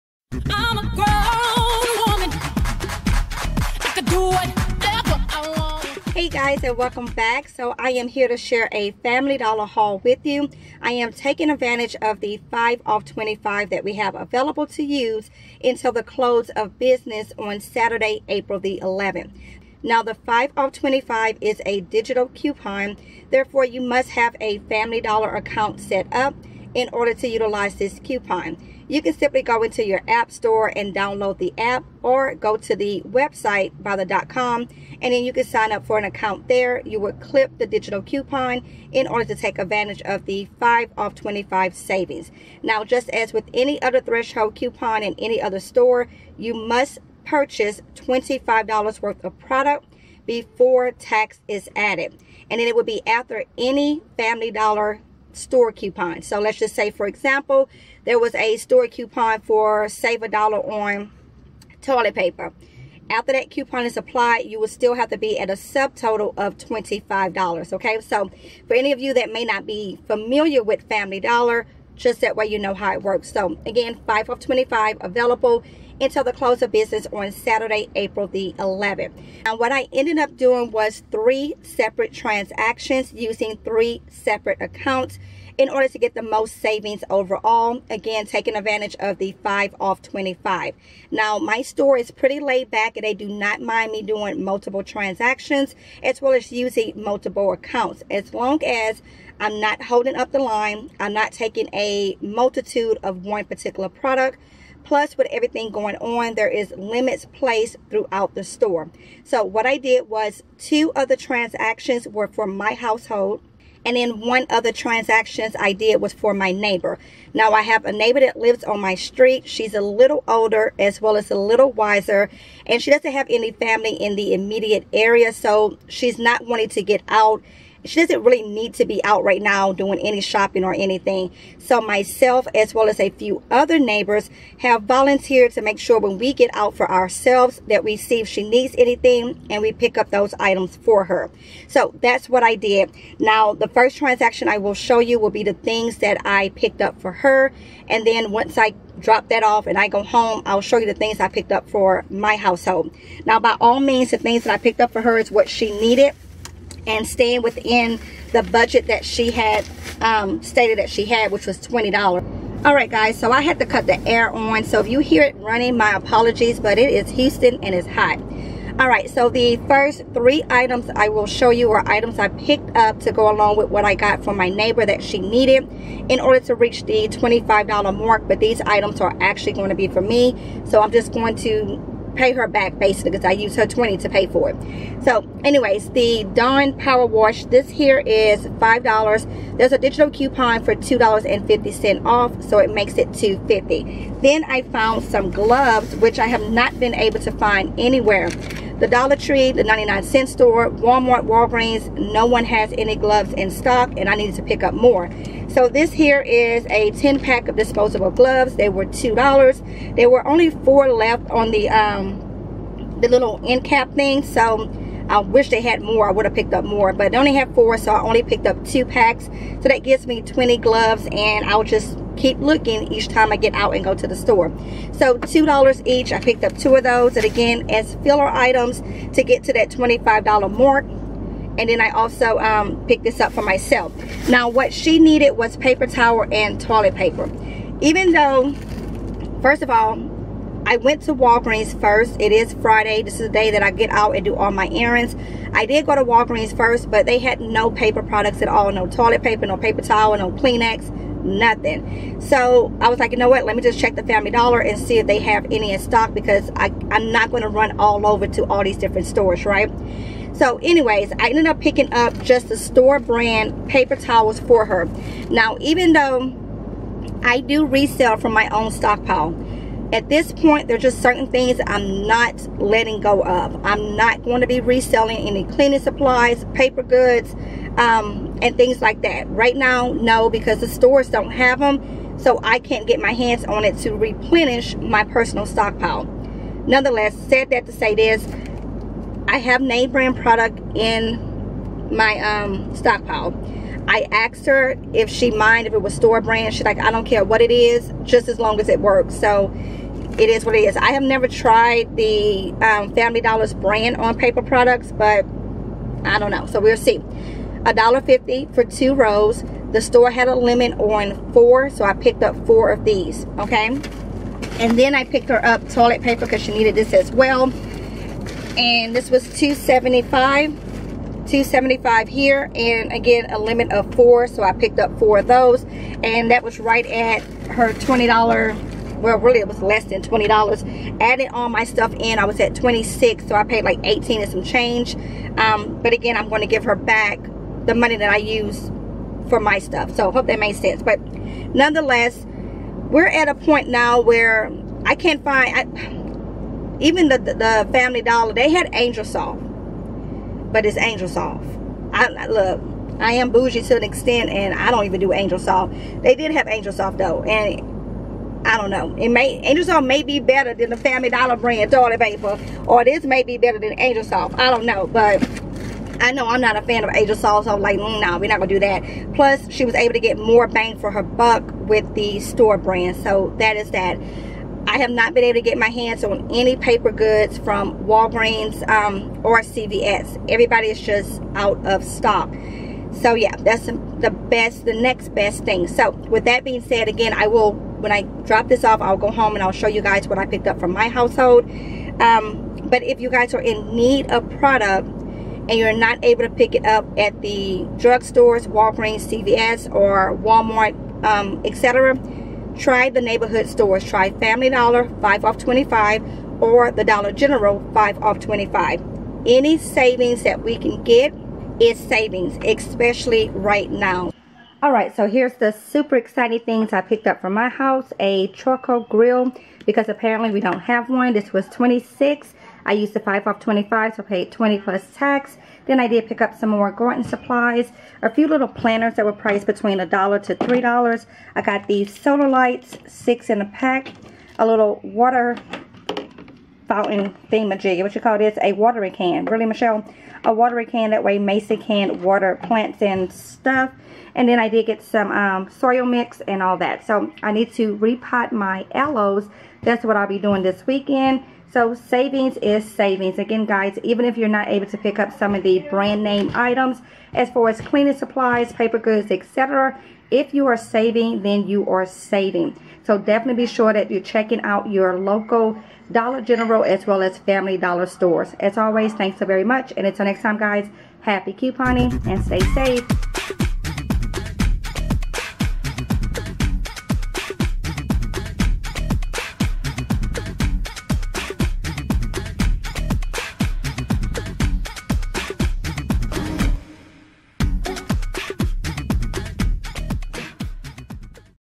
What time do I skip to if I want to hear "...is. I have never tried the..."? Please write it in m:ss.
5:00.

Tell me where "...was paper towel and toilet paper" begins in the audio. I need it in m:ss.
3:55.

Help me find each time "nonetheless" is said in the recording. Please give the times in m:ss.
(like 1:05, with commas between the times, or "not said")
4:46, 5:41.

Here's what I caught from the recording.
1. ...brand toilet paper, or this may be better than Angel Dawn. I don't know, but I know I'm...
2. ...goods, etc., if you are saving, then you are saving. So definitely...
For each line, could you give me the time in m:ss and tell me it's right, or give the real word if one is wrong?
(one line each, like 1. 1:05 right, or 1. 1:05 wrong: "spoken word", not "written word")
1. 6:01 wrong: "Soft", not "Dawn"
2. 7:38 right.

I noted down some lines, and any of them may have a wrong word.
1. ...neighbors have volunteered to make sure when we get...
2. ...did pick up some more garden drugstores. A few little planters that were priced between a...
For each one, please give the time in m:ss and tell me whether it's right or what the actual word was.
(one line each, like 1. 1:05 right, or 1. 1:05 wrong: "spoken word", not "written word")
1. 2:13 right
2. 7:05 wrong: "supplies", not "drugstores".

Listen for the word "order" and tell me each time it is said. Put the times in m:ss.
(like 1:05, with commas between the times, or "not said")
0:26, 0:39, 1:25, 2:56.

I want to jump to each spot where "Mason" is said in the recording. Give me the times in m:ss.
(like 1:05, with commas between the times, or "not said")
7:21.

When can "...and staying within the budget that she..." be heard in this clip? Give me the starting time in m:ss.
2:36.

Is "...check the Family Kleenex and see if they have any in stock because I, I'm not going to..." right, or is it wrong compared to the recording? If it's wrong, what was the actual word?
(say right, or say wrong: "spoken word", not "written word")
wrong: "Dollar", not "Kleenex".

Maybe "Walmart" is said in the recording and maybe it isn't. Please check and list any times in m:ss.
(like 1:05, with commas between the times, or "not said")
3:20, 6:40.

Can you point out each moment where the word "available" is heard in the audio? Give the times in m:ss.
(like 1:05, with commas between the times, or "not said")
0:14, 1:15.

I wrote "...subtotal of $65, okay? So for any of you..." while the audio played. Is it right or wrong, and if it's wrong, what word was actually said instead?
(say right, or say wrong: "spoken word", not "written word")
wrong: "25", not "65".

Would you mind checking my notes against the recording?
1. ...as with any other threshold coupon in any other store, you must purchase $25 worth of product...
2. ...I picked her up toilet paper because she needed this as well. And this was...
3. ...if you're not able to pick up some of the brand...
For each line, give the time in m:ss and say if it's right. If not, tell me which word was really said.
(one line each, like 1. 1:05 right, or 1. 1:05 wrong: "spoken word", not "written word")
1. 0:43 right
2. 5:14 right
3. 7:34 right.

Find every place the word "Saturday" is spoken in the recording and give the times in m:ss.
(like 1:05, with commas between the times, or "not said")
0:17, 1:17.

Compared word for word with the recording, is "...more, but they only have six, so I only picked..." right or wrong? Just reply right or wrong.
wrong.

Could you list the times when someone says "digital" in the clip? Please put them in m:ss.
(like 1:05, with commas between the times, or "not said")
0:21, 0:37, 3:09.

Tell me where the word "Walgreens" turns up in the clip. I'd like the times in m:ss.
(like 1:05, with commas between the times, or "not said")
3:21, 4:01, 4:06, 6:17, 6:38.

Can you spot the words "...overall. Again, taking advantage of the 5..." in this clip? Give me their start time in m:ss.
1:27.